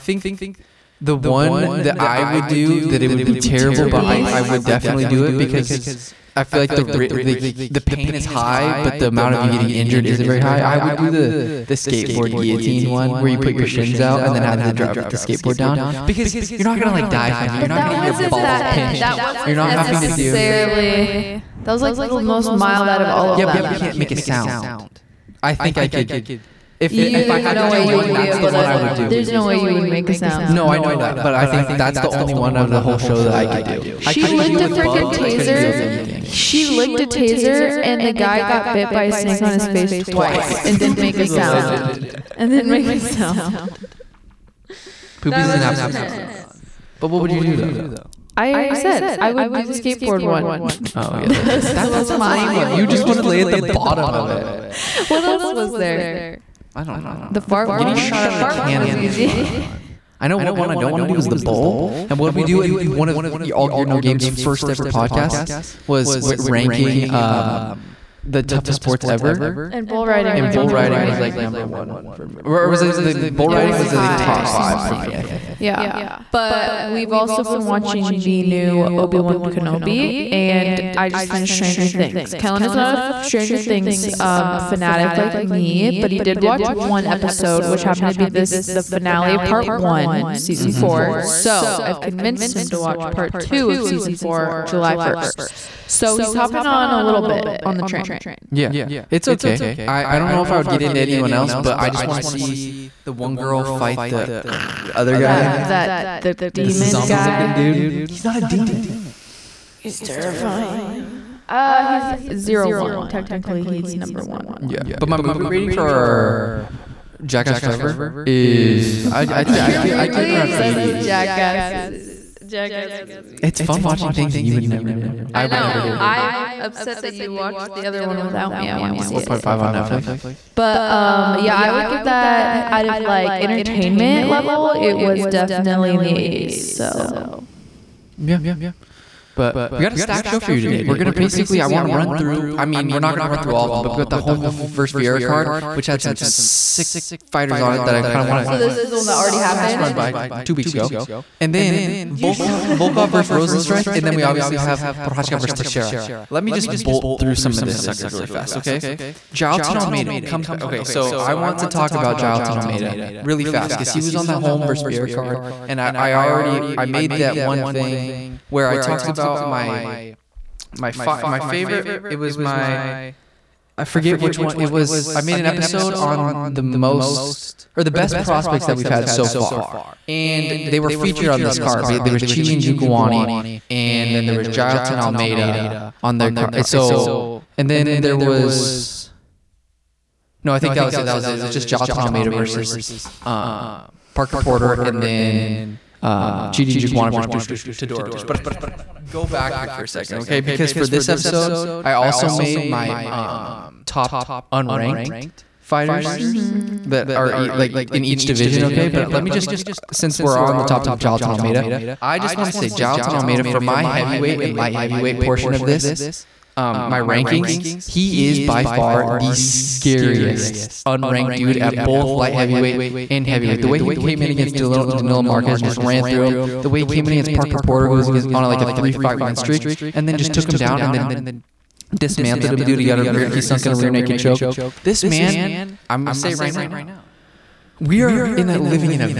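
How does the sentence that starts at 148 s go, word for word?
So this is the one that already happened.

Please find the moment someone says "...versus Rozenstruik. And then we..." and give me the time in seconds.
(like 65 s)
153 s.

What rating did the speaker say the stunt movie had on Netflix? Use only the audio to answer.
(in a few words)
4.5.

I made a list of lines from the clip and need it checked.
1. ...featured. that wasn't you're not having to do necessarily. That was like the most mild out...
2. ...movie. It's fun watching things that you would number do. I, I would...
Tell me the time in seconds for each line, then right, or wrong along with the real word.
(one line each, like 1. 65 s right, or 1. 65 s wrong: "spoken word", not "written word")
1. 18 s wrong: "pinched", not "featured"
2. 123 s wrong: "never", not "number".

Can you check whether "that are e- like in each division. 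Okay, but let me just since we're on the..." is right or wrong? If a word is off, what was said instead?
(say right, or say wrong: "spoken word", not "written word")
right.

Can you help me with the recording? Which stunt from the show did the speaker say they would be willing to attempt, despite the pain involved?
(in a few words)
Skateboard guillotine.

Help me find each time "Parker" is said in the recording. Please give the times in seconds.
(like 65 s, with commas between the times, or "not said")
194 s, 227 s.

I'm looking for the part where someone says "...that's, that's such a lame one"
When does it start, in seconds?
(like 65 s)
51 s.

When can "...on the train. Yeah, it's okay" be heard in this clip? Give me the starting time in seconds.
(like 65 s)
97 s.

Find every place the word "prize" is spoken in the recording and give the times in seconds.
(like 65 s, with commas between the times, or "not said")
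not said.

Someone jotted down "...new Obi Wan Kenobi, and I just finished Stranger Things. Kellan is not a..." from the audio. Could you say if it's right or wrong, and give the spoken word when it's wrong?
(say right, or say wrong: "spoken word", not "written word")
right.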